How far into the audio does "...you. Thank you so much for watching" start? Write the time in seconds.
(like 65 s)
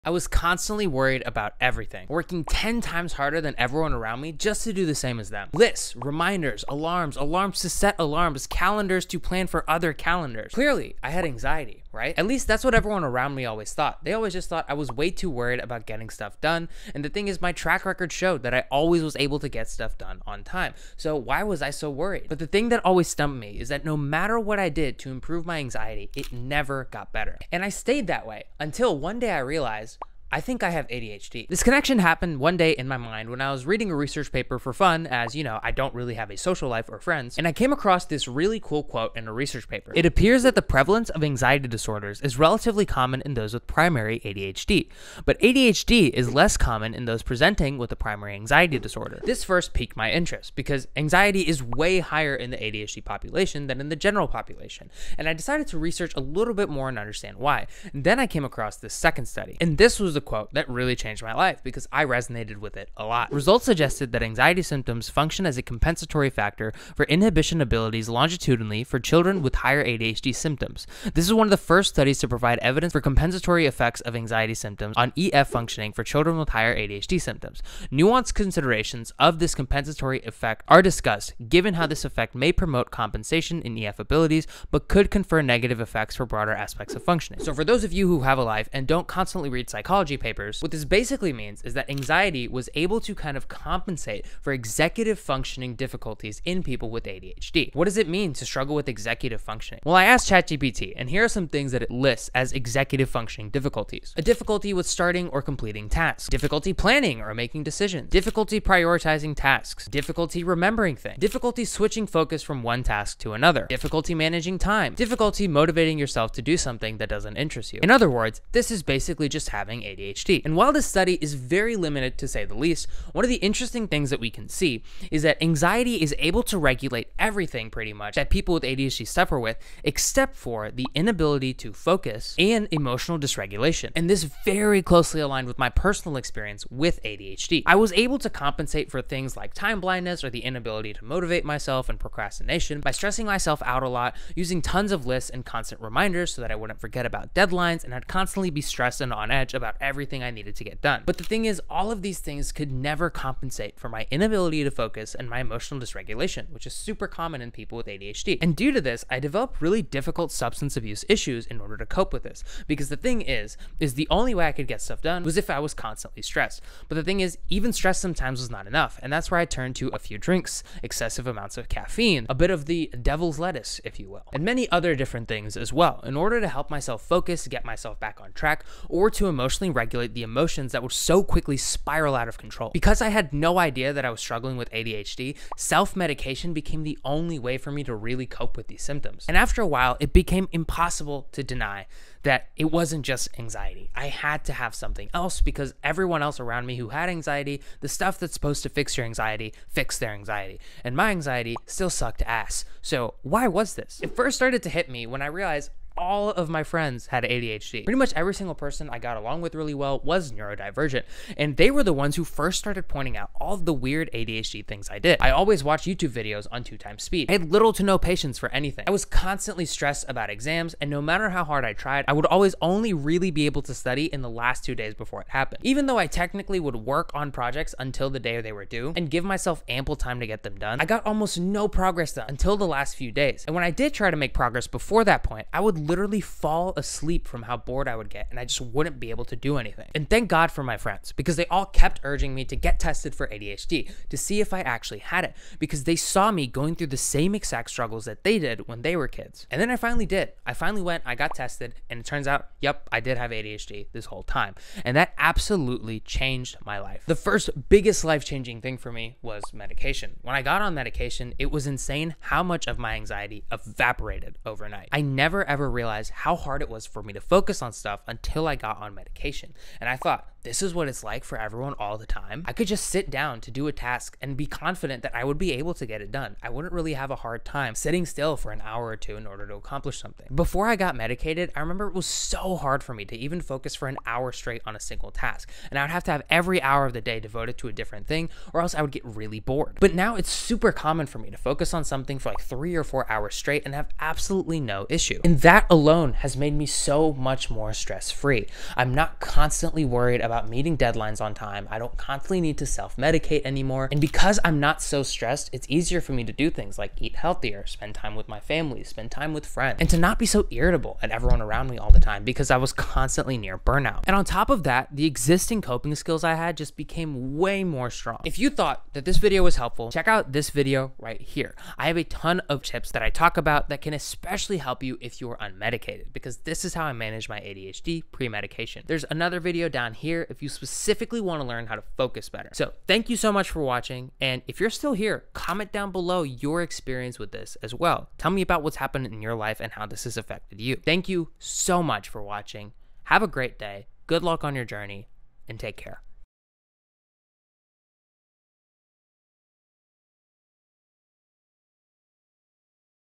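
340 s.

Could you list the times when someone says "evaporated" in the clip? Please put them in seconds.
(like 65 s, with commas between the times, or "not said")
263 s.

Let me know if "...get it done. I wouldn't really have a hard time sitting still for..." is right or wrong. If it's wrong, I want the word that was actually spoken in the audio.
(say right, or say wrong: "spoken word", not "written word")
right.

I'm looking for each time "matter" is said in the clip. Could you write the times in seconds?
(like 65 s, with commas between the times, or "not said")
23 s, 221 s.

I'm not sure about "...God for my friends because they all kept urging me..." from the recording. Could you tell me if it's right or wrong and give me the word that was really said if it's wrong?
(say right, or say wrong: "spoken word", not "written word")
right.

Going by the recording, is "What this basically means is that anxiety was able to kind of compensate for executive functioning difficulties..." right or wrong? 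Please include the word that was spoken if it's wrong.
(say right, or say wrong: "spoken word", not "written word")
right.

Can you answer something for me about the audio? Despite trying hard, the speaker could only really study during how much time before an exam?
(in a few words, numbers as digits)
Last 2 days.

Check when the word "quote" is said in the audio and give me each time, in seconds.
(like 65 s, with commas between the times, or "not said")
38 s, 60 s.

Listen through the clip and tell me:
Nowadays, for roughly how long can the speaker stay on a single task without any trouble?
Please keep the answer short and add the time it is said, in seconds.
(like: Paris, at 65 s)
3 or 4 hours, at 292 s.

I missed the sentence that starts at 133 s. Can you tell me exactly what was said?
And this very closely aligned with my personal experience with ADHD.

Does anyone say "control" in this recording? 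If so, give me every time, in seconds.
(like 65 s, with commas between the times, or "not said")
182 s.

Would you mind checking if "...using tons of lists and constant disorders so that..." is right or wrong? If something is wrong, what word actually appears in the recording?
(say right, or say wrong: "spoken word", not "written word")
wrong: "reminders", not "disorders".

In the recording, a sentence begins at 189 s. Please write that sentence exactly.
And after a while, it became impossible to deny that it wasn't just anxiety.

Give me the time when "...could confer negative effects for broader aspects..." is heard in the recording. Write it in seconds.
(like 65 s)
84 s.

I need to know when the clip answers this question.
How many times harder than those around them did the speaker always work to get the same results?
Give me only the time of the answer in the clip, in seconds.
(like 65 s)
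2 s.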